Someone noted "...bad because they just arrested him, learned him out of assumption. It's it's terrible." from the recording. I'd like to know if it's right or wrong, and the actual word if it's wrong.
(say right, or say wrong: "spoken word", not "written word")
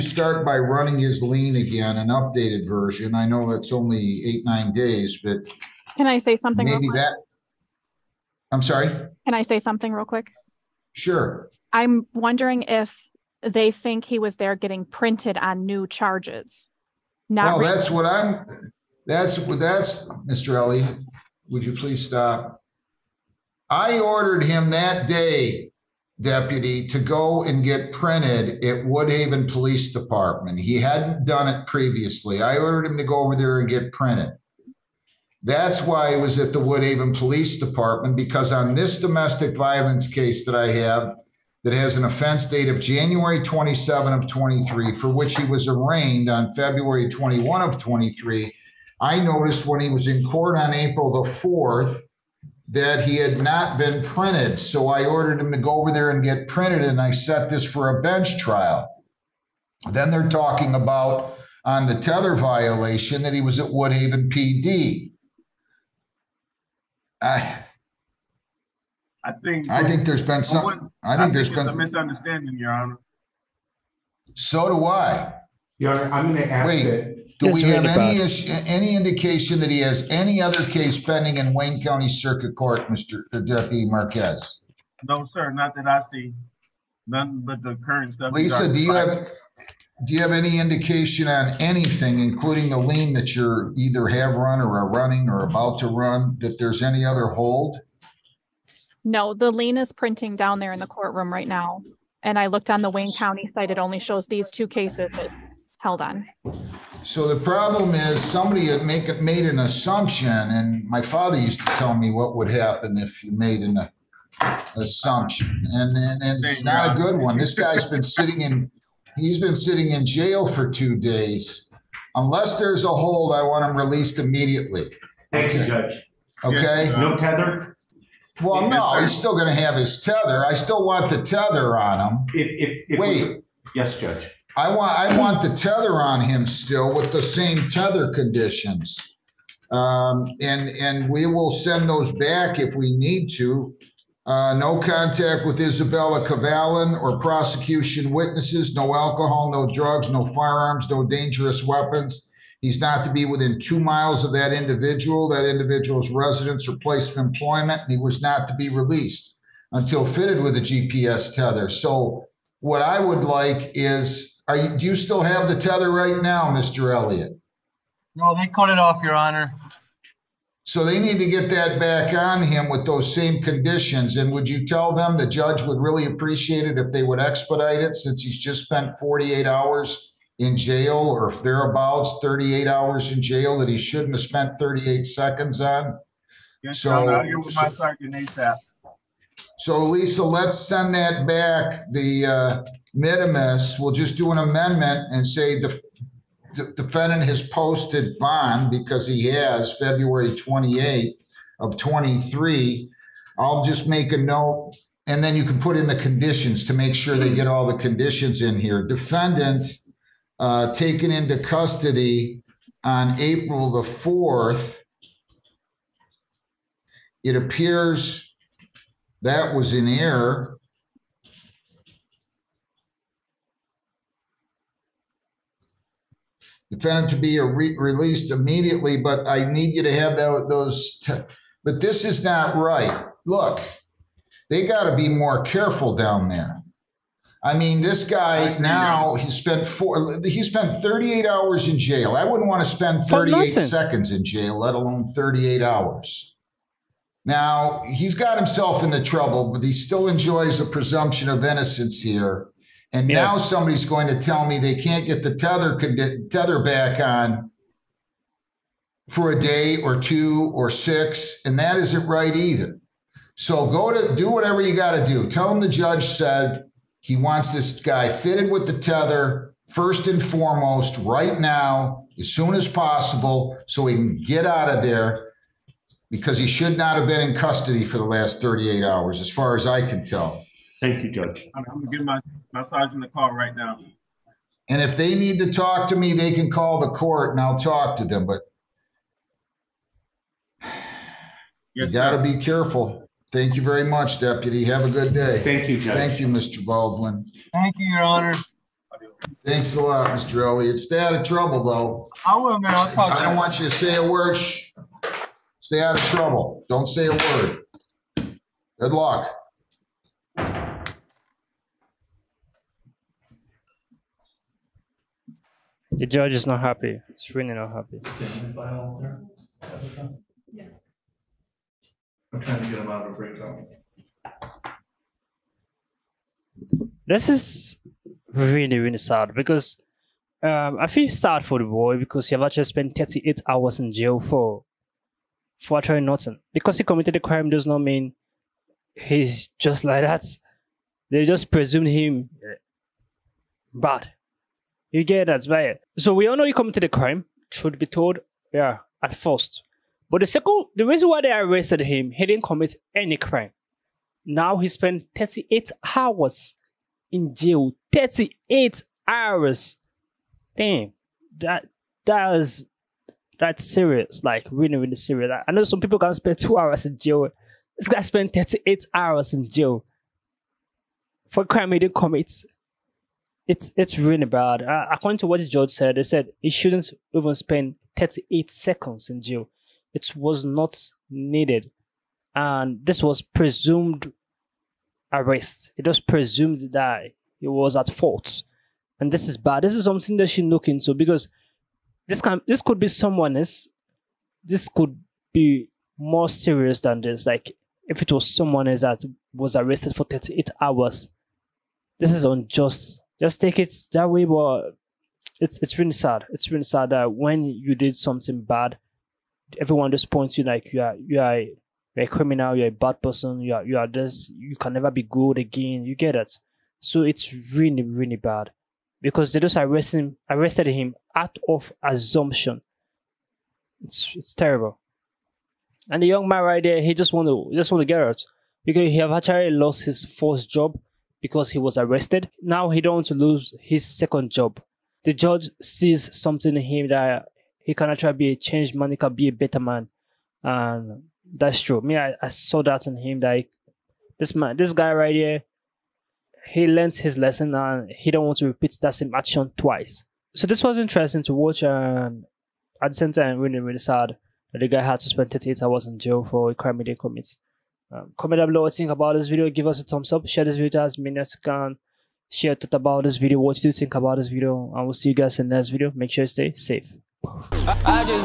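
wrong: "arrested", not "learned".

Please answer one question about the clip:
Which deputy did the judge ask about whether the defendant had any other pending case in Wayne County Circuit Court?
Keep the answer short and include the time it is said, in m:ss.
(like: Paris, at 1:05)
Marquez, at 1:23.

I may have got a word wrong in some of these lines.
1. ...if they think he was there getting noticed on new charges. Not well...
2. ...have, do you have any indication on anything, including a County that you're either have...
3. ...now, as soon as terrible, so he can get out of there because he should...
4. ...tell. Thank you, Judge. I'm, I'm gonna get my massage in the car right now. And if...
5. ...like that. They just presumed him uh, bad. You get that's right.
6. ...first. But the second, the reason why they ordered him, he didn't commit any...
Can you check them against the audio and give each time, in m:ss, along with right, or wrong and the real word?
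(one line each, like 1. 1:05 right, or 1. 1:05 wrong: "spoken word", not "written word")
1. 0:12 wrong: "printed", not "noticed"
2. 1:28 wrong: "LEIN", not "County"
3. 4:31 wrong: "possible", not "terrible"
4. 4:40 right
5. 5:39 right
6. 5:49 wrong: "arrested", not "ordered".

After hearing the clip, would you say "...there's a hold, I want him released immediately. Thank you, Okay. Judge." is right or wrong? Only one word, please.
right.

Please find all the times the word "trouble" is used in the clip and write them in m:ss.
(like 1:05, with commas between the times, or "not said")
4:09, 5:01, 5:06.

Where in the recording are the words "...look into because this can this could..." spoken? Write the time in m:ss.
6:30.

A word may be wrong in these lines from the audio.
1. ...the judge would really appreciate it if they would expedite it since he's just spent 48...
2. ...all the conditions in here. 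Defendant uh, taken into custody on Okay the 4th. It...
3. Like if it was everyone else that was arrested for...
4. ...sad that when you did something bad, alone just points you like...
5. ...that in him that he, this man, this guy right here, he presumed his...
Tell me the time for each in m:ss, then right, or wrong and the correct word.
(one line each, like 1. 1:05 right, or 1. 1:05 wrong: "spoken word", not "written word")
1. 2:55 right
2. 3:27 wrong: "April", not "Okay"
3. 6:37 wrong: "someone", not "everyone"
4. 6:46 wrong: "everyone", not "alone"
5. 7:22 wrong: "learned", not "presumed".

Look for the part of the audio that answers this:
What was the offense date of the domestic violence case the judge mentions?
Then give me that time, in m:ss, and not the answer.
0:42.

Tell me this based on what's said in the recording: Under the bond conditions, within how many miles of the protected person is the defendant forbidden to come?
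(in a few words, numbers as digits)
2 miles.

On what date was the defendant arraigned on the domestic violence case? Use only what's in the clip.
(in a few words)
February 21, 2023.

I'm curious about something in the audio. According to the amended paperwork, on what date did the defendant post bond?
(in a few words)
February 28, 2023.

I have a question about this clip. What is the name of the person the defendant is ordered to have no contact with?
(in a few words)
Isabella Cavallan.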